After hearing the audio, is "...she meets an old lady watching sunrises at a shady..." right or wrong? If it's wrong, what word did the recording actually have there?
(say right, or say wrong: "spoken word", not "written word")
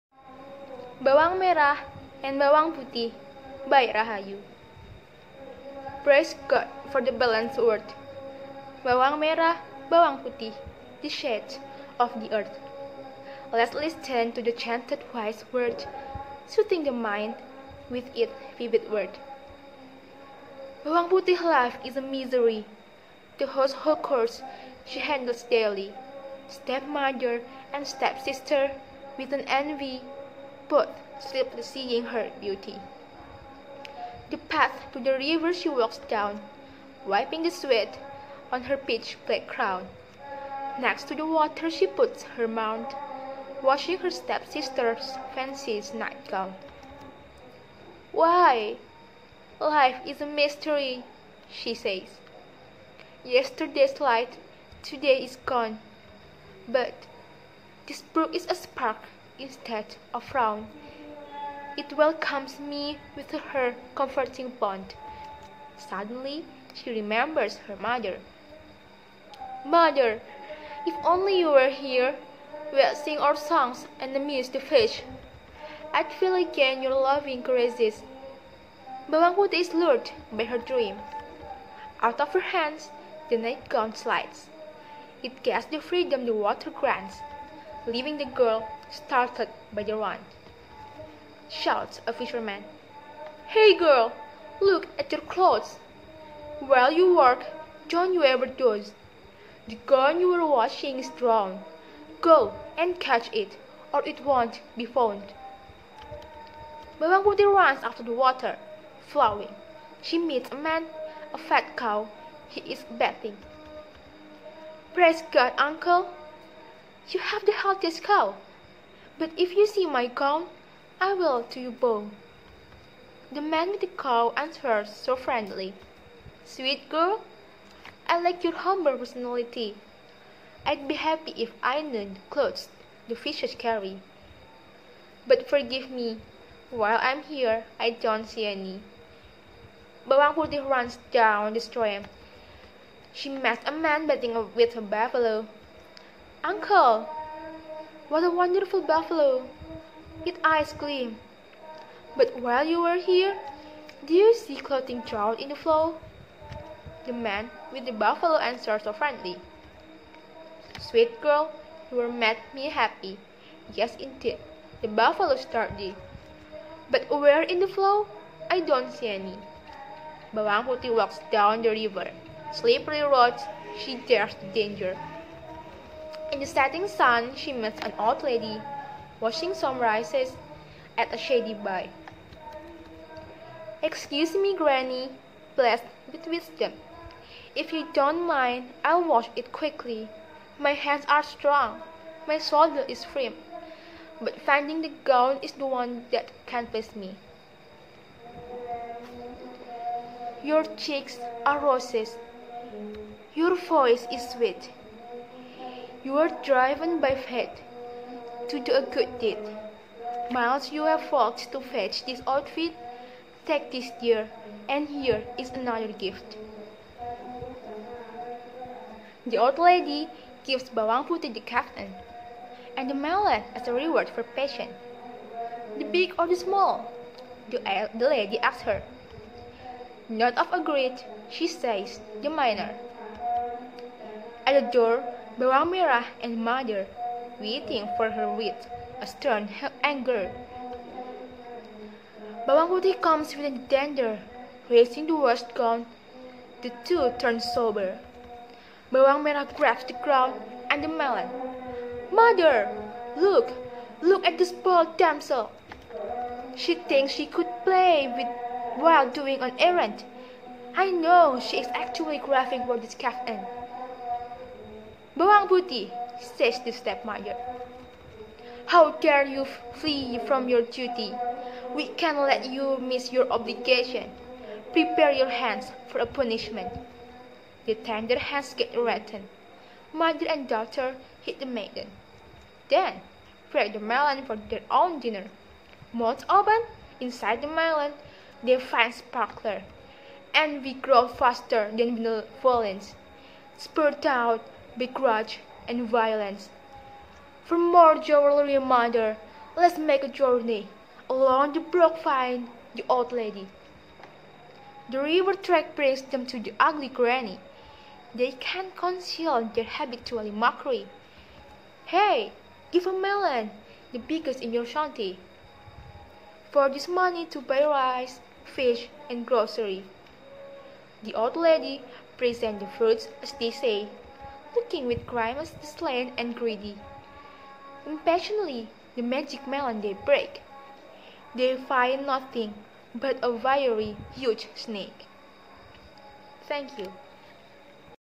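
right.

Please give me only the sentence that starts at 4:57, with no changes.
For more jewelry reminder, let's make a journey along the brook find the old lady.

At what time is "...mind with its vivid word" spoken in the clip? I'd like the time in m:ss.
0:16.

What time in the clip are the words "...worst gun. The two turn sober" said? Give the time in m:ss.
4:05.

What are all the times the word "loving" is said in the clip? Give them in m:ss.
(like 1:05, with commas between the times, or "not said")
1:16.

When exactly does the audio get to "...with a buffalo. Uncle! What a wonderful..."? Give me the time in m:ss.
2:24.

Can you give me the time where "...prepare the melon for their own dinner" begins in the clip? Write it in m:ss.
4:43.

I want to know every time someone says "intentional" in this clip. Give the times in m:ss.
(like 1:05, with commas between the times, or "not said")
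not said.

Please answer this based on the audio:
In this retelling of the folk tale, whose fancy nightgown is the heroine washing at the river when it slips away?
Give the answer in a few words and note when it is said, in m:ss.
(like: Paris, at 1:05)
Her stepsister's, at 0:44.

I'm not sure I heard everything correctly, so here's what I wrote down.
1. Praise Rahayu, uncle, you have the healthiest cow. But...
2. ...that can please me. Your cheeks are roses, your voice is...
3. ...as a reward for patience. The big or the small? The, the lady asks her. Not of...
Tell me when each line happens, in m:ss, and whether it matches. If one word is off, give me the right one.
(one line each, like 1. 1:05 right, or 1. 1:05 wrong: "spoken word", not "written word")
1. 1:54 wrong: "God", not "Rahayu"
2. 3:16 right
3. 3:43 right.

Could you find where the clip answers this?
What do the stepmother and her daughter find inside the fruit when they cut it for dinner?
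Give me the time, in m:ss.
4:48.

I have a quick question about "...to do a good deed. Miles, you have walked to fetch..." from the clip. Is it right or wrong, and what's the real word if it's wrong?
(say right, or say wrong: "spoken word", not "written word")
right.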